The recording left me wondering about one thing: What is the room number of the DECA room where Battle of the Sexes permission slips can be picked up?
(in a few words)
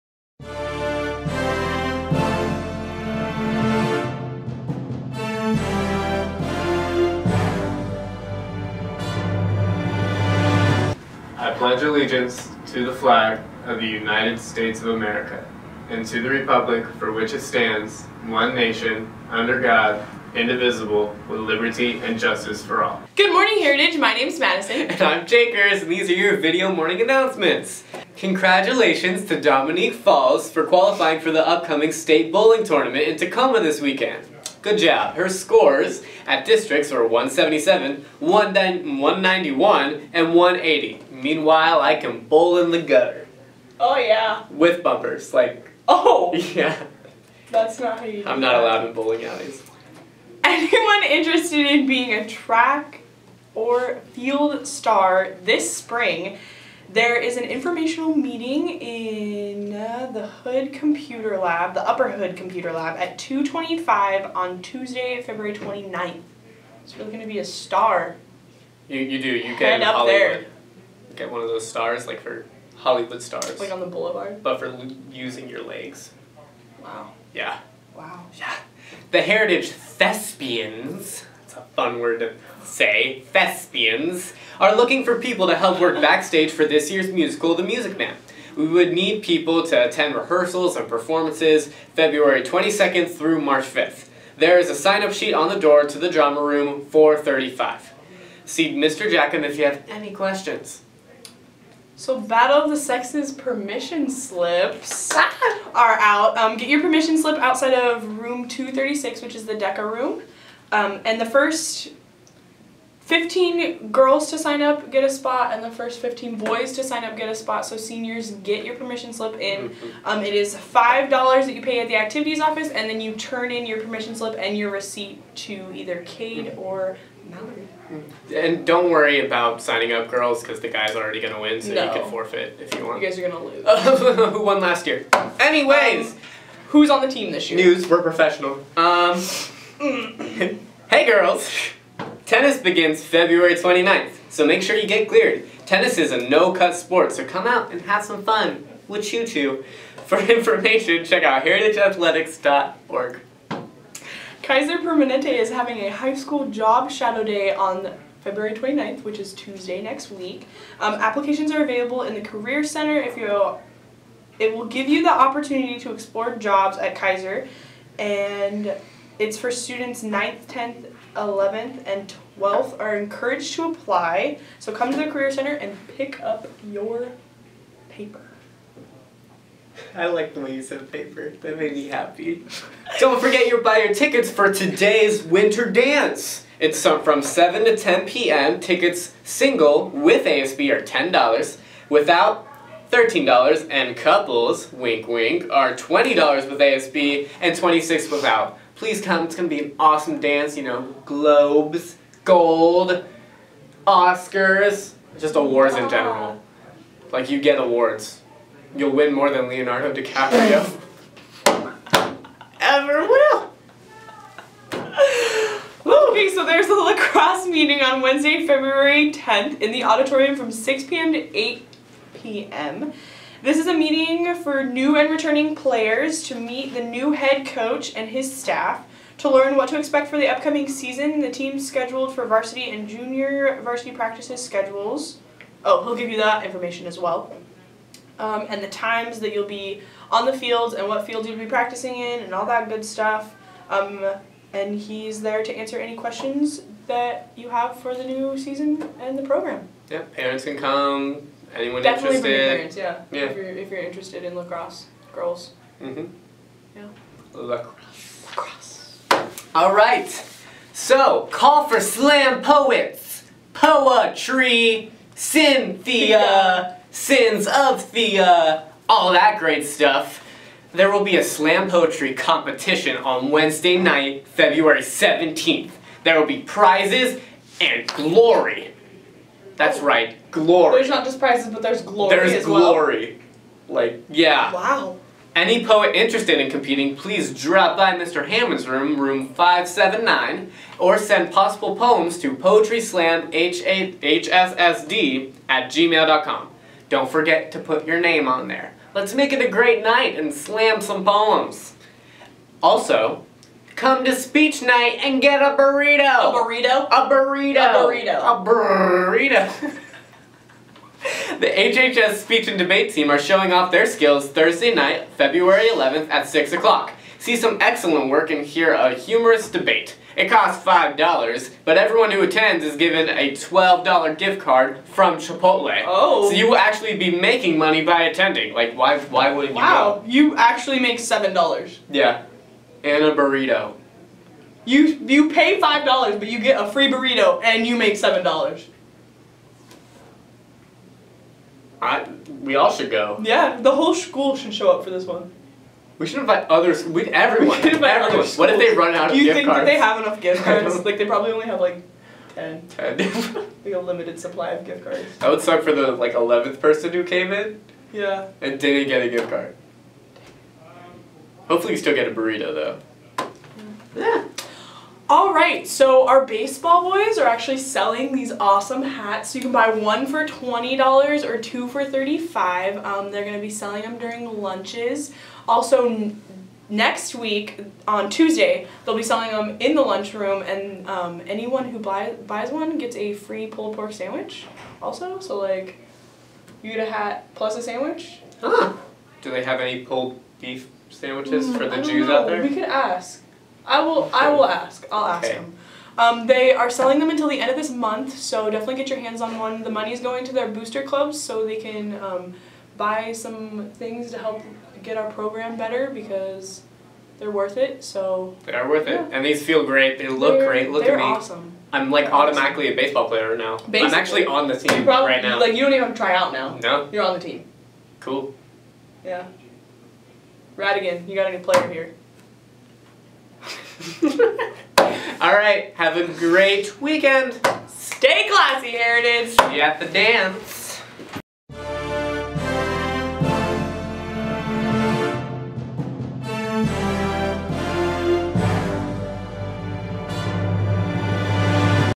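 236.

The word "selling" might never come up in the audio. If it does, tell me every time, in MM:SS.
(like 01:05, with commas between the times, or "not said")
06:07, 06:13, 06:19, 06:36.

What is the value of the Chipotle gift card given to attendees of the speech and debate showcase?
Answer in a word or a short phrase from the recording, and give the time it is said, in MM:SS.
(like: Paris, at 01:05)
$12, at 05:23.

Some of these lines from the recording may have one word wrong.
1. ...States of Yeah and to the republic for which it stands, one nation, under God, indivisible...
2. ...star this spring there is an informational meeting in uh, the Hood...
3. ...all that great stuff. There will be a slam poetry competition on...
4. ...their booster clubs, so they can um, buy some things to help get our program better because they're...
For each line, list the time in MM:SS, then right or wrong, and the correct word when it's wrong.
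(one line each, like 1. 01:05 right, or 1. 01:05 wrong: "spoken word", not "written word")
1. 00:14 wrong: "America", not "Yeah"
2. 00:54 right
3. 04:28 right
4. 06:40 right.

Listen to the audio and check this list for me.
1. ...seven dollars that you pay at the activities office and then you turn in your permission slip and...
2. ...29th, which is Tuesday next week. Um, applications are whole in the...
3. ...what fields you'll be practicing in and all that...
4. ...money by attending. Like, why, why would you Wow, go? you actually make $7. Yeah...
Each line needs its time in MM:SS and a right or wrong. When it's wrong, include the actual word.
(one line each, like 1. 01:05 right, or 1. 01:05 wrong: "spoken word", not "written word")
1. 02:00 wrong: "five", not "seven"
2. 02:38 wrong: "available", not "whole"
3. 04:00 right
4. 05:27 right.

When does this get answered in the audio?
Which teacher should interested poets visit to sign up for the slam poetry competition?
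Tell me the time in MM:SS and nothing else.
04:47.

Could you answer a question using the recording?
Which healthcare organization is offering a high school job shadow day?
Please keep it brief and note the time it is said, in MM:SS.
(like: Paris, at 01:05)
Kaiser Permanente, at 02:34.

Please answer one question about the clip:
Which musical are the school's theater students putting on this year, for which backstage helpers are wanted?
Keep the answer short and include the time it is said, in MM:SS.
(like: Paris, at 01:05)
The Music Man, at 01:27.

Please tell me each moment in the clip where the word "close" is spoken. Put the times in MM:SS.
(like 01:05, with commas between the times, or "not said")
not said.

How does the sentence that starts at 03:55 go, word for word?
Oh, he'll give you that information as well.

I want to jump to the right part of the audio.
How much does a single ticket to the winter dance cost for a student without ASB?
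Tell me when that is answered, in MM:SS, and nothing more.
03:12.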